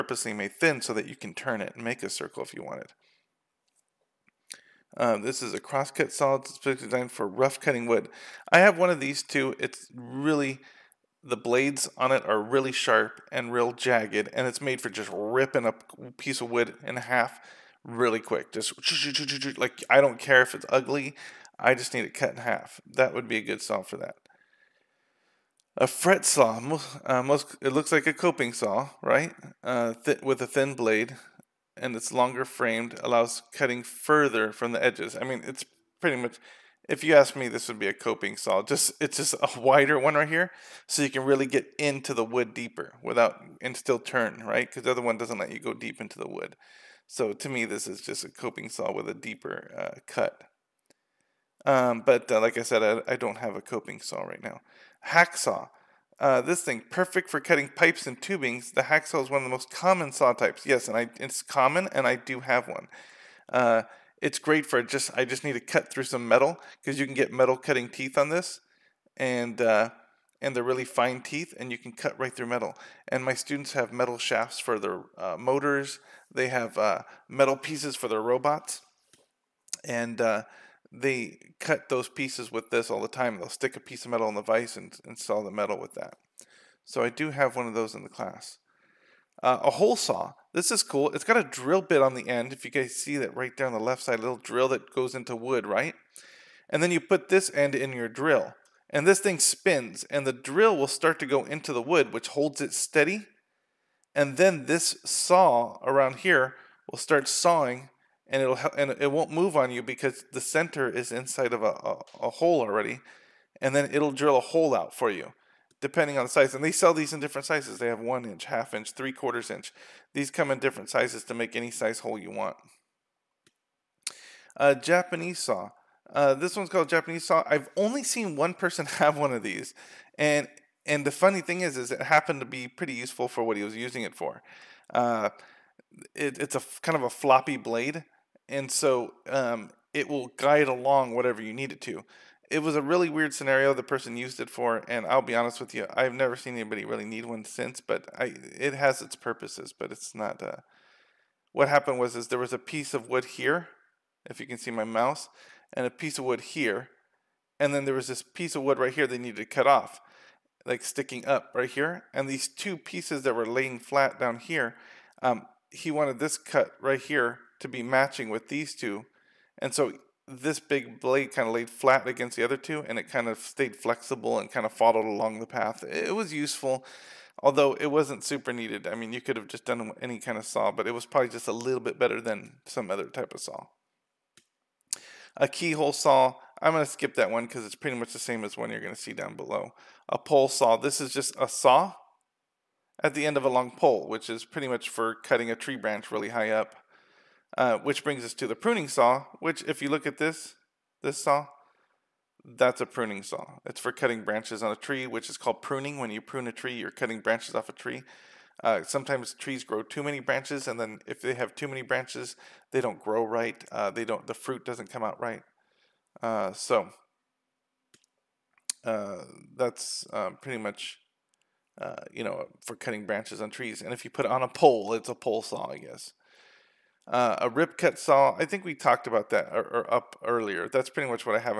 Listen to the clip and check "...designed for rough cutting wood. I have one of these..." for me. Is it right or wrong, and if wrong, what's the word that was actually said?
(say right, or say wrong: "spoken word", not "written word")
right.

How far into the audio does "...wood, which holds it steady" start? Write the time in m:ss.
1:41.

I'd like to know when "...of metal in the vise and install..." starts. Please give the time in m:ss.
1:24.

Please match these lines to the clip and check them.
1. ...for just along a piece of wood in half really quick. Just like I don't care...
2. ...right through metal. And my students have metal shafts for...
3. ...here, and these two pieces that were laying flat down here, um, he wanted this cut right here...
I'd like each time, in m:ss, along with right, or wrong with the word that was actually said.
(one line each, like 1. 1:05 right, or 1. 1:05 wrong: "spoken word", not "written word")
1. 0:14 wrong: "ripping", not "along"
2. 1:12 right
3. 2:41 right.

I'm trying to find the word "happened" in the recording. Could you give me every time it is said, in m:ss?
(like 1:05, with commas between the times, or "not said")
2:12, 2:31.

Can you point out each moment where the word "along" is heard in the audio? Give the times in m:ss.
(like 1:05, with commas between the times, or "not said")
2:20, 2:55.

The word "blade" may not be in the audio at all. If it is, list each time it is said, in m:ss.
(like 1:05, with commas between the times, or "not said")
0:11, 0:30, 2:17, 2:50.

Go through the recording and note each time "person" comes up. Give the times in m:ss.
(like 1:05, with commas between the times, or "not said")
2:08, 2:23.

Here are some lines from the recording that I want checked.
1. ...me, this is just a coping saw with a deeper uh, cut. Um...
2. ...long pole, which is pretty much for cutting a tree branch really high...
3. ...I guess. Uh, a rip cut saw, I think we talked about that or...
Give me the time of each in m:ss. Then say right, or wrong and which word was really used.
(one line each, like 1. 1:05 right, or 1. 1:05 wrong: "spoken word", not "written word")
1. 0:47 right
2. 3:13 right
3. 3:45 right.